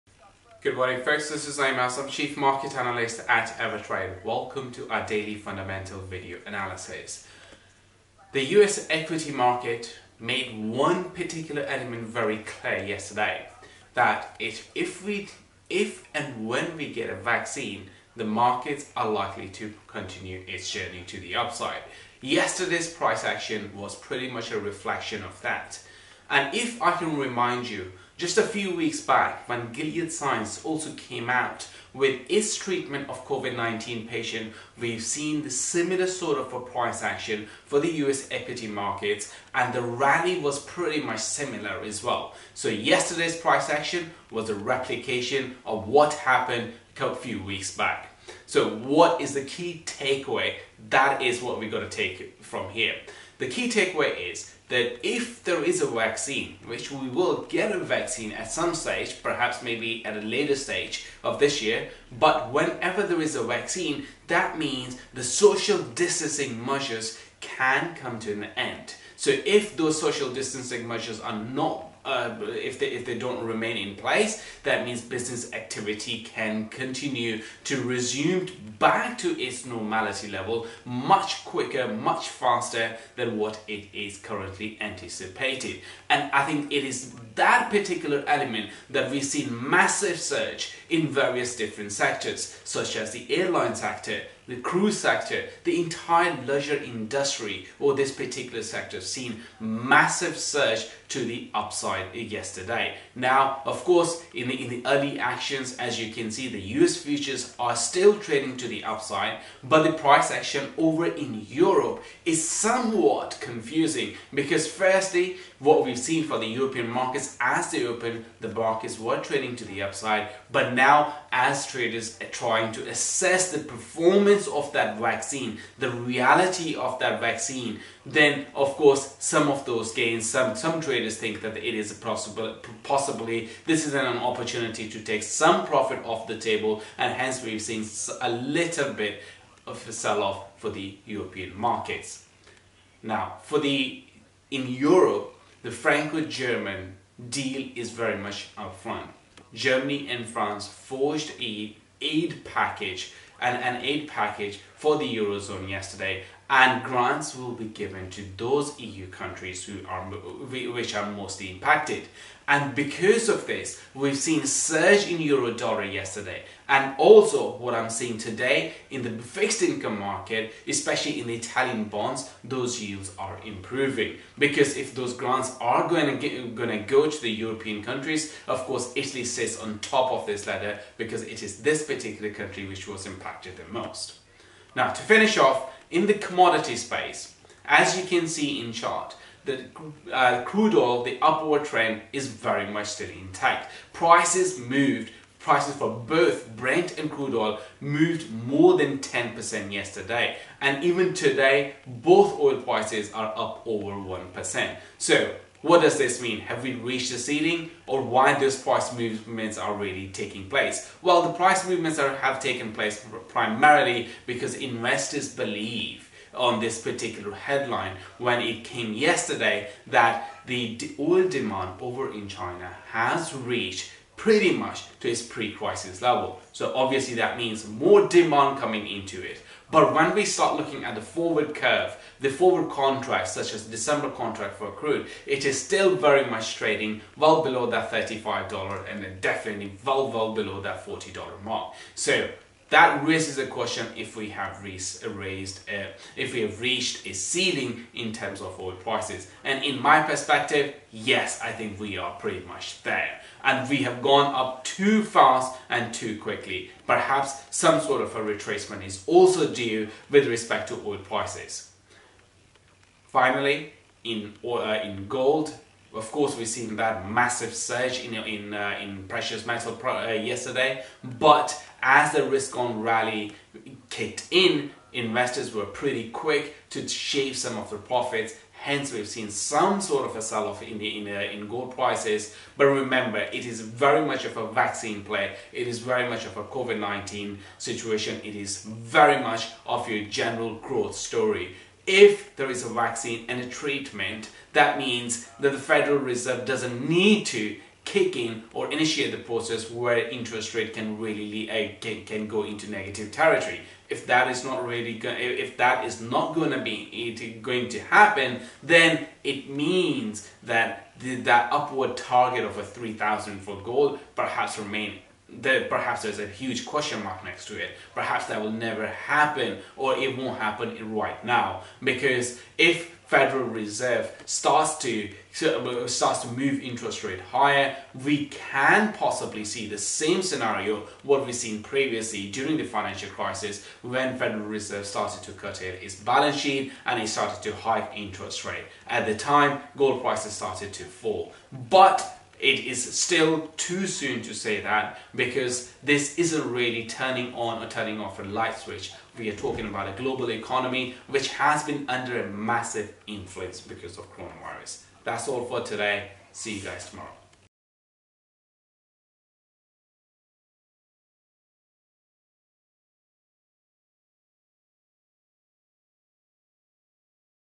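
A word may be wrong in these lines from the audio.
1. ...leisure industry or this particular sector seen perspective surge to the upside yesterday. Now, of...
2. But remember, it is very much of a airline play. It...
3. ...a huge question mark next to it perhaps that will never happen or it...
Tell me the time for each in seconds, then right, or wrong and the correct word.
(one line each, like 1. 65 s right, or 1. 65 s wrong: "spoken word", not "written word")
1. 96 s wrong: "massive", not "perspective"
2. 282 s wrong: "vaccine", not "airline"
3. 316 s right.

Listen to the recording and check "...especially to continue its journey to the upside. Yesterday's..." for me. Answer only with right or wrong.
wrong.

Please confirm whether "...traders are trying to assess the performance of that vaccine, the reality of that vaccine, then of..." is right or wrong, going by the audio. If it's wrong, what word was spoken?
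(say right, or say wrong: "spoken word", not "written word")
right.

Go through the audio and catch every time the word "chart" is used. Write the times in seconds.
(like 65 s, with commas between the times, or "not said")
188 s.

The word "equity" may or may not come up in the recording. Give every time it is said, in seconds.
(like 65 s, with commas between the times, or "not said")
8 s, 38 s.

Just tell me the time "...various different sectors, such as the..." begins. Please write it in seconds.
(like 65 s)
91 s.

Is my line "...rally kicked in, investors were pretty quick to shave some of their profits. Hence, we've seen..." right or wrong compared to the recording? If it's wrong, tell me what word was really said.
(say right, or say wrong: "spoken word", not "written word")
right.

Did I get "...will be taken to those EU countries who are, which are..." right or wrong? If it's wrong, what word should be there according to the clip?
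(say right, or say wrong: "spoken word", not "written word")
wrong: "given", not "taken".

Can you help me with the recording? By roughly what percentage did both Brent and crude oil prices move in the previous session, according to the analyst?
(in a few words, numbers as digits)
10%.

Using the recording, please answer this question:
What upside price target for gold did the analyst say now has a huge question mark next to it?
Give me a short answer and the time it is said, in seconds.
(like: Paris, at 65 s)
3000, at 312 s.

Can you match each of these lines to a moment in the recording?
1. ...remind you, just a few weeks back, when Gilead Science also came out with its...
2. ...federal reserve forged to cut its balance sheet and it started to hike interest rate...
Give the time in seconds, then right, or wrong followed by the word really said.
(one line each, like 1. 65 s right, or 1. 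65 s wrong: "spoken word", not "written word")
1. 27 s right
2. 334 s wrong: "started", not "forged".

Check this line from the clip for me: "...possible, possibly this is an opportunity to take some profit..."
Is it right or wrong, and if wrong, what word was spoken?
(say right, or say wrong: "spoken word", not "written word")
right.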